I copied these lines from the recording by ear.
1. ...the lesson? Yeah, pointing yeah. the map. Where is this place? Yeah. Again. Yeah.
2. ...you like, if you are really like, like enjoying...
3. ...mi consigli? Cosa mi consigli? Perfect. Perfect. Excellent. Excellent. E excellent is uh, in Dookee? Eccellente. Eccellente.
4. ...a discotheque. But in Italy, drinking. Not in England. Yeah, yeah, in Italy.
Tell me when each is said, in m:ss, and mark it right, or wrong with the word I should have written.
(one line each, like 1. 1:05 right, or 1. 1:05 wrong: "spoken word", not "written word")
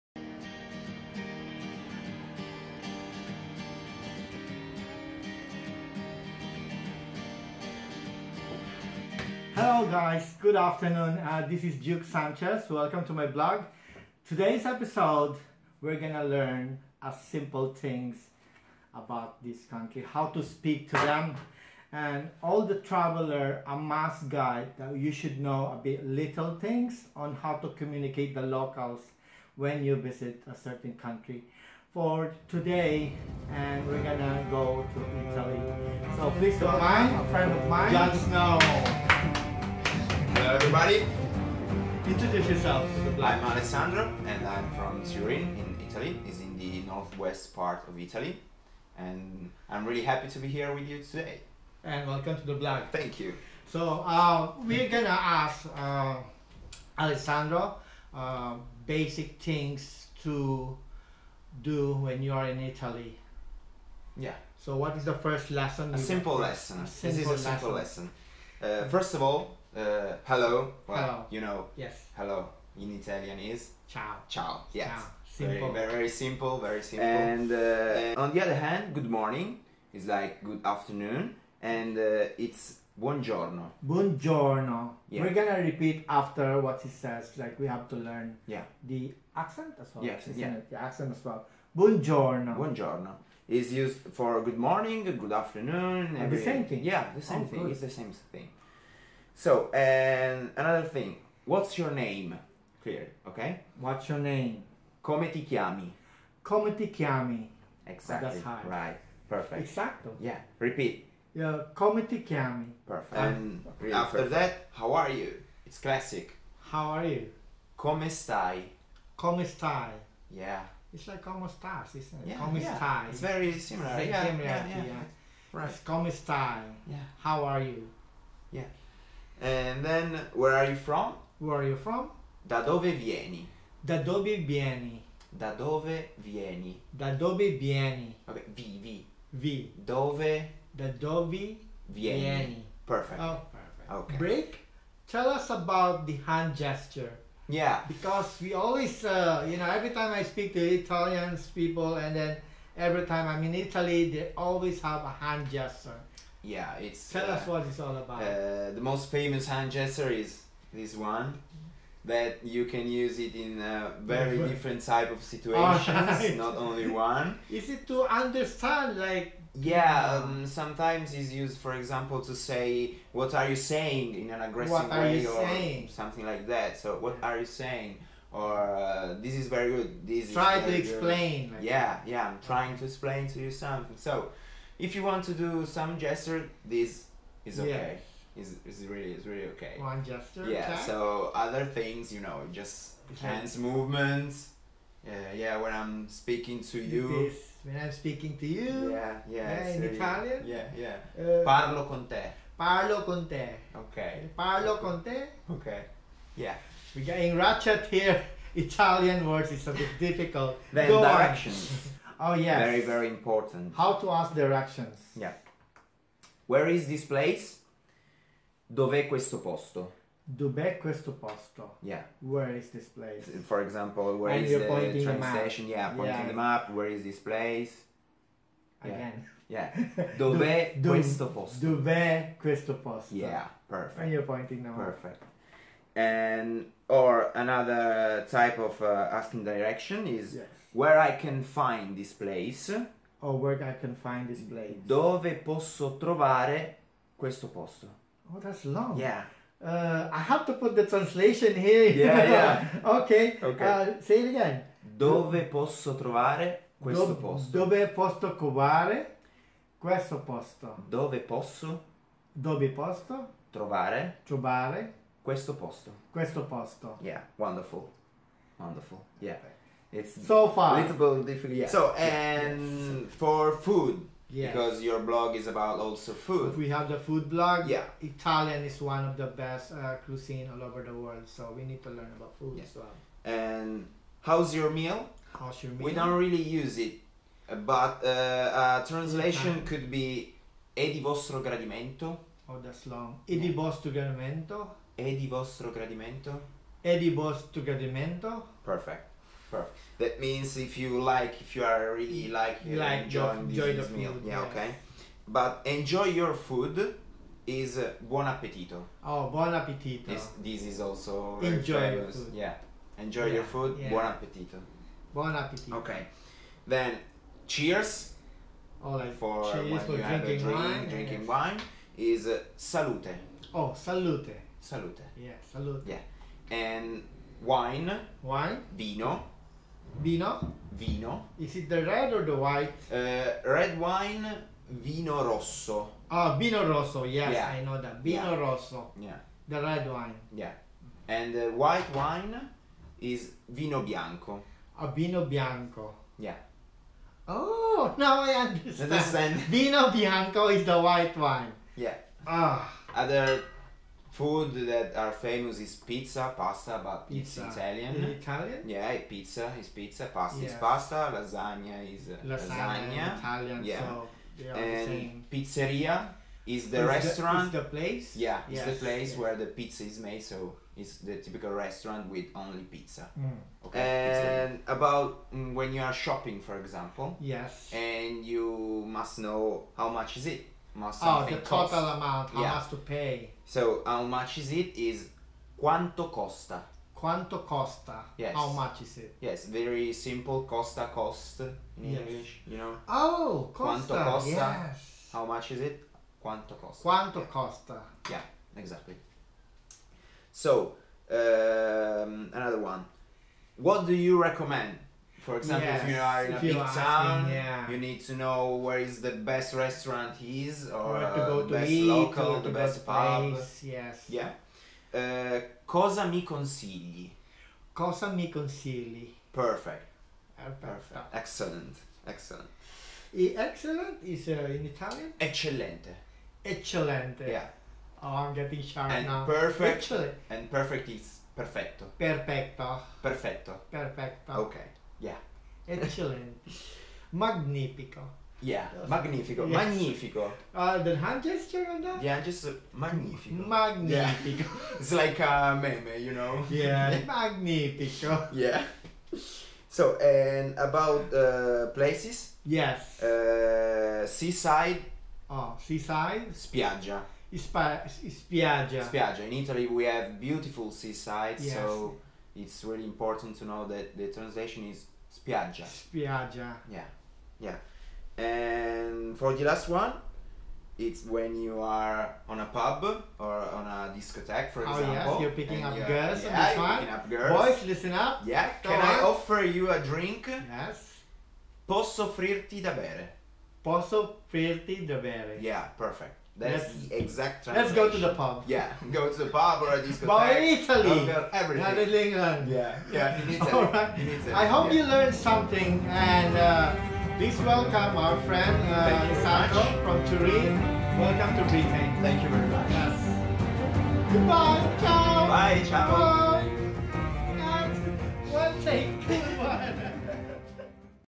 1. 3:45 wrong: "station", not "lesson"
2. 5:00 right
3. 6:56 wrong: "Italian", not "Dookee"
4. 8:09 wrong: "everything", not "drinking".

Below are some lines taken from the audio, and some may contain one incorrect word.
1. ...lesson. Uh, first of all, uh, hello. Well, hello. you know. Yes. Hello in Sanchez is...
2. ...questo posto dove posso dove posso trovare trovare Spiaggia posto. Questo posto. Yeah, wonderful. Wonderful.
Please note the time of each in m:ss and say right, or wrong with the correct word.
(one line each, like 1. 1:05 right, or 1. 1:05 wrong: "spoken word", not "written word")
1. 1:07 wrong: "Italian", not "Sanchez"
2. 4:19 wrong: "Questo", not "Spiaggia".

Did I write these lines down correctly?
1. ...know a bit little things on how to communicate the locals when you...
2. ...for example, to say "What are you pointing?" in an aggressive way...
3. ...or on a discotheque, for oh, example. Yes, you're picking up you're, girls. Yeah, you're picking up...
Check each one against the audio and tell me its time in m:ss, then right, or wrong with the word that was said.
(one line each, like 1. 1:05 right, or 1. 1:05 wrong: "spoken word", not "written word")
1. 0:25 right
2. 2:51 wrong: "saying", not "pointing"
3. 7:53 right.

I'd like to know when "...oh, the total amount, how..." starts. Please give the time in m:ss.
6:21.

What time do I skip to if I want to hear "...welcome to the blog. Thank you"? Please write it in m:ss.
0:52.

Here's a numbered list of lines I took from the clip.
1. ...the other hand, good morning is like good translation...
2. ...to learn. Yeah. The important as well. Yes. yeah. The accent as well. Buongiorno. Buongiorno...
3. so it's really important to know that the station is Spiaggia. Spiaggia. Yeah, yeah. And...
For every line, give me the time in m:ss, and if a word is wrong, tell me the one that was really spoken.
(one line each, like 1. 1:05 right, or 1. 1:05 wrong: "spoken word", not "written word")
1. 1:18 wrong: "afternoon", not "translation"
2. 1:27 wrong: "accent", not "important"
3. 7:41 wrong: "translation", not "station".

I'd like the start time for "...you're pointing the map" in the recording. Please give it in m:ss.
3:54.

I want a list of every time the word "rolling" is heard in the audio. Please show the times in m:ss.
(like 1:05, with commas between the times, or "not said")
not said.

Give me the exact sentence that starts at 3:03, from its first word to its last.
So if you want to do some gesture, this is okay.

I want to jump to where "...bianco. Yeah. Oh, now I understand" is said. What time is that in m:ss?
5:45.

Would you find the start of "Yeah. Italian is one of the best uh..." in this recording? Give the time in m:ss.
4:37.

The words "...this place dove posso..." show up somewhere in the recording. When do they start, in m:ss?
4:04.